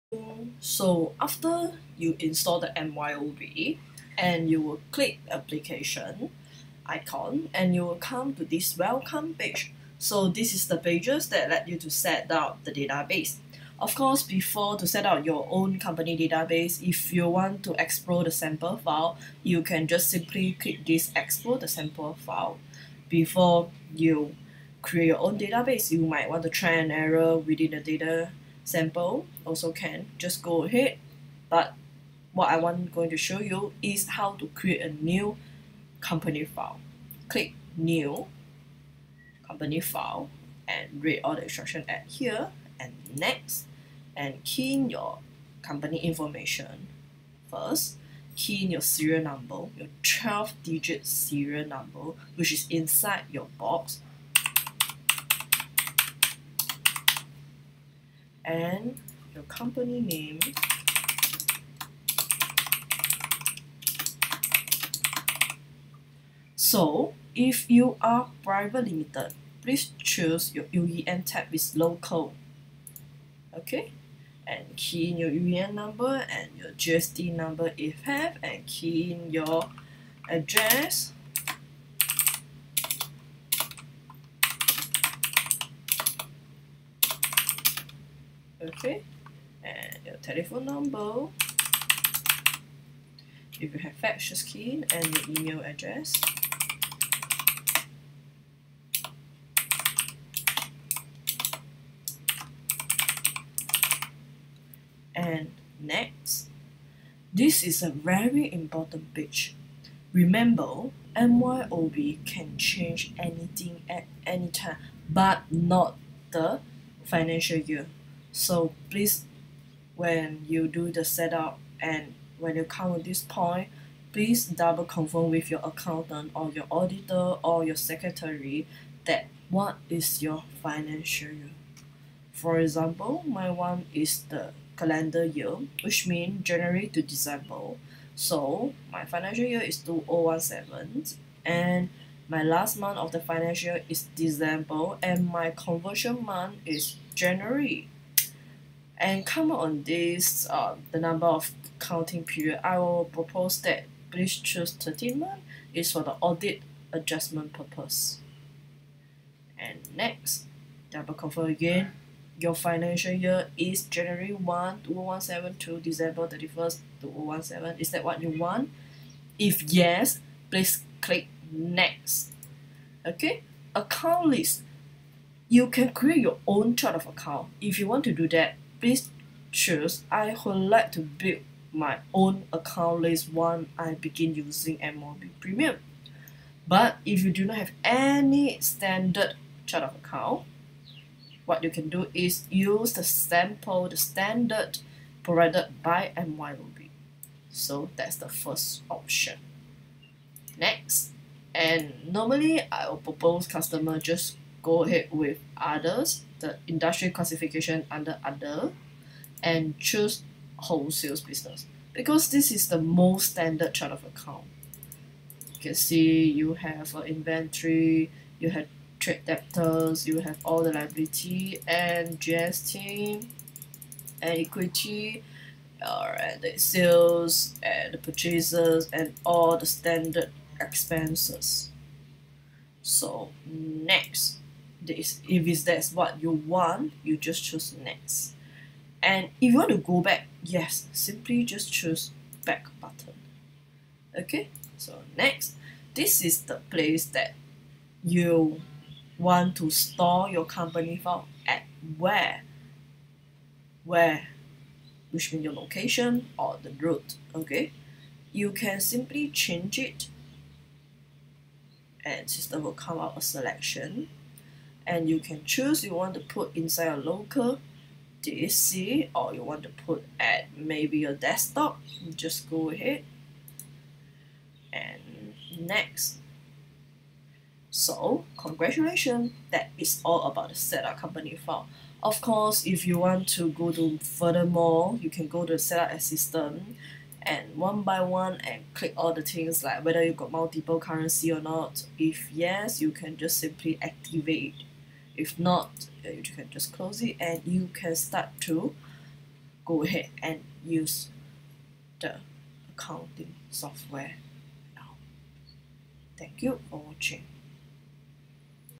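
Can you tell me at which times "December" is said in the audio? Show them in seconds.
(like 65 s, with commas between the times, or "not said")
137 s, 144 s, 165 s.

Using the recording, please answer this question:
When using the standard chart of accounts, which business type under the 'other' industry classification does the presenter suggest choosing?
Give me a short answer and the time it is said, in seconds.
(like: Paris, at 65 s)
wholesale business, at 210 s.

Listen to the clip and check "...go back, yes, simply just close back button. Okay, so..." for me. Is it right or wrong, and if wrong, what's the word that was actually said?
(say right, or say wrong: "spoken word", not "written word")
wrong: "choose", not "close".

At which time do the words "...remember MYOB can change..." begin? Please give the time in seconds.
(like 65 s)
110 s.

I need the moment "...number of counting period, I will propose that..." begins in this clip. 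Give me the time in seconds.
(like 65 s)
150 s.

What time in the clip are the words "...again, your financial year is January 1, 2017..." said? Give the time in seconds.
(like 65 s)
161 s.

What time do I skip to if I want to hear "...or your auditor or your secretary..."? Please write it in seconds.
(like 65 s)
126 s.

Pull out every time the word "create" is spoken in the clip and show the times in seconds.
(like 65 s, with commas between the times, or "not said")
24 s, 34 s, 175 s.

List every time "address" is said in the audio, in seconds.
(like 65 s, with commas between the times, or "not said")
80 s, 95 s.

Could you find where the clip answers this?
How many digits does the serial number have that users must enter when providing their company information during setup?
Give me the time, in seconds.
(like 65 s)
50 s.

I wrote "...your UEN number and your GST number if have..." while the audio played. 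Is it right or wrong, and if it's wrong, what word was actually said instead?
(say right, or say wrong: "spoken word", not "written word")
right.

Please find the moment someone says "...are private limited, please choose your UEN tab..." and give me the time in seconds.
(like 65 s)
67 s.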